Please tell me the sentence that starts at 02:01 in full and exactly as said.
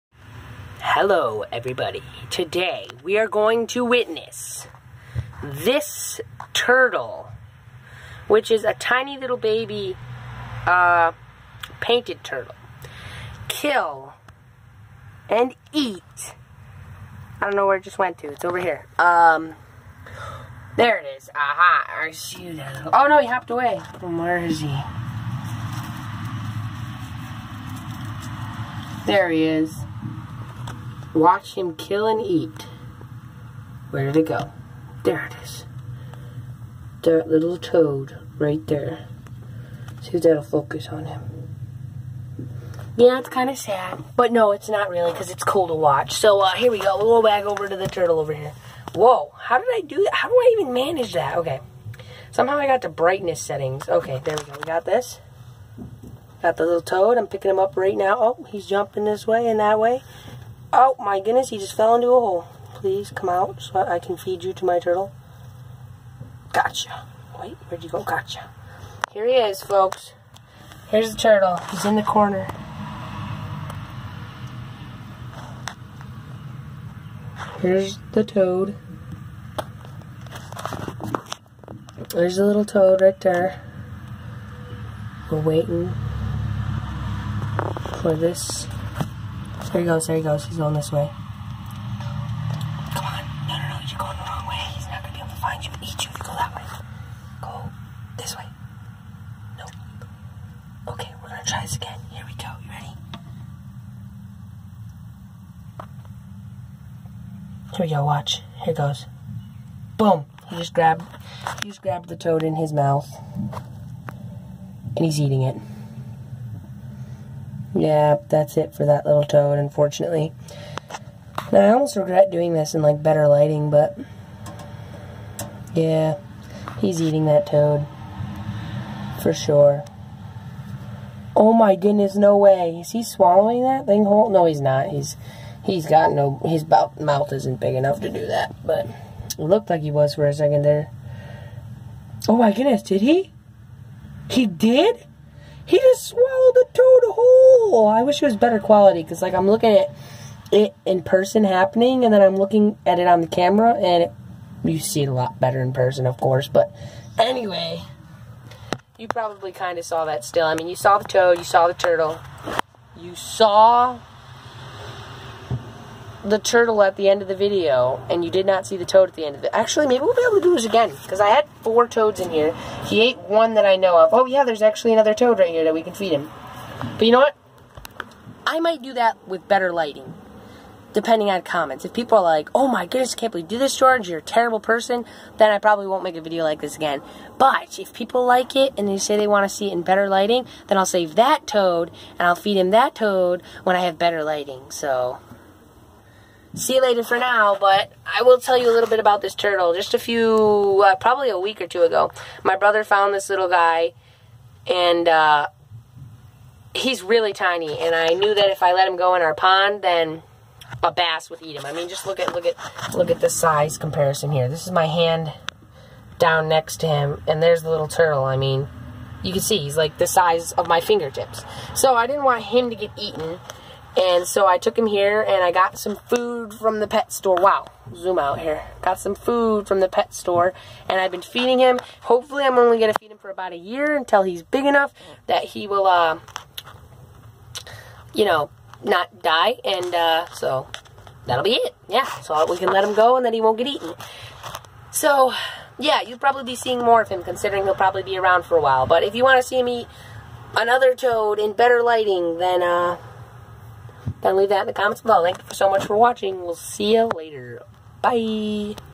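Now, I almost regret doing this in, like, better lighting, but...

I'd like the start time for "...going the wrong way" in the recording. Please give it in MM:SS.
01:33.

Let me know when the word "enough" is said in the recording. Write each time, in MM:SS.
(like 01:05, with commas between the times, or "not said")
02:17, 03:54.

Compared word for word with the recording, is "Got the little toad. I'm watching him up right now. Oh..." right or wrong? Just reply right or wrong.
wrong.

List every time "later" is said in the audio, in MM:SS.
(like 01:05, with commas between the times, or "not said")
03:16, 04:17.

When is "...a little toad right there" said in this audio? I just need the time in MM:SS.
01:22.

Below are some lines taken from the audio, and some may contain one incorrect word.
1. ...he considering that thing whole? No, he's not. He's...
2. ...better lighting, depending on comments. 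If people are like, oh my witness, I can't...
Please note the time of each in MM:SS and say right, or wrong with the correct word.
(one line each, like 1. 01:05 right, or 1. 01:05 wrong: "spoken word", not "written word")
1. 02:12 wrong: "swallowing", not "considering"
2. 02:59 wrong: "goodness", not "witness".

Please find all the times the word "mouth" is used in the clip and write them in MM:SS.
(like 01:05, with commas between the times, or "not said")
01:52, 02:16.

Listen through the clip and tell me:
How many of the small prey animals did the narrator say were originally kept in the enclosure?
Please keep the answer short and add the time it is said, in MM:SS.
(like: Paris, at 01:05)
4, at 02:51.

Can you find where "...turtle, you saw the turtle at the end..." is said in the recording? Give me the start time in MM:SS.
02:41.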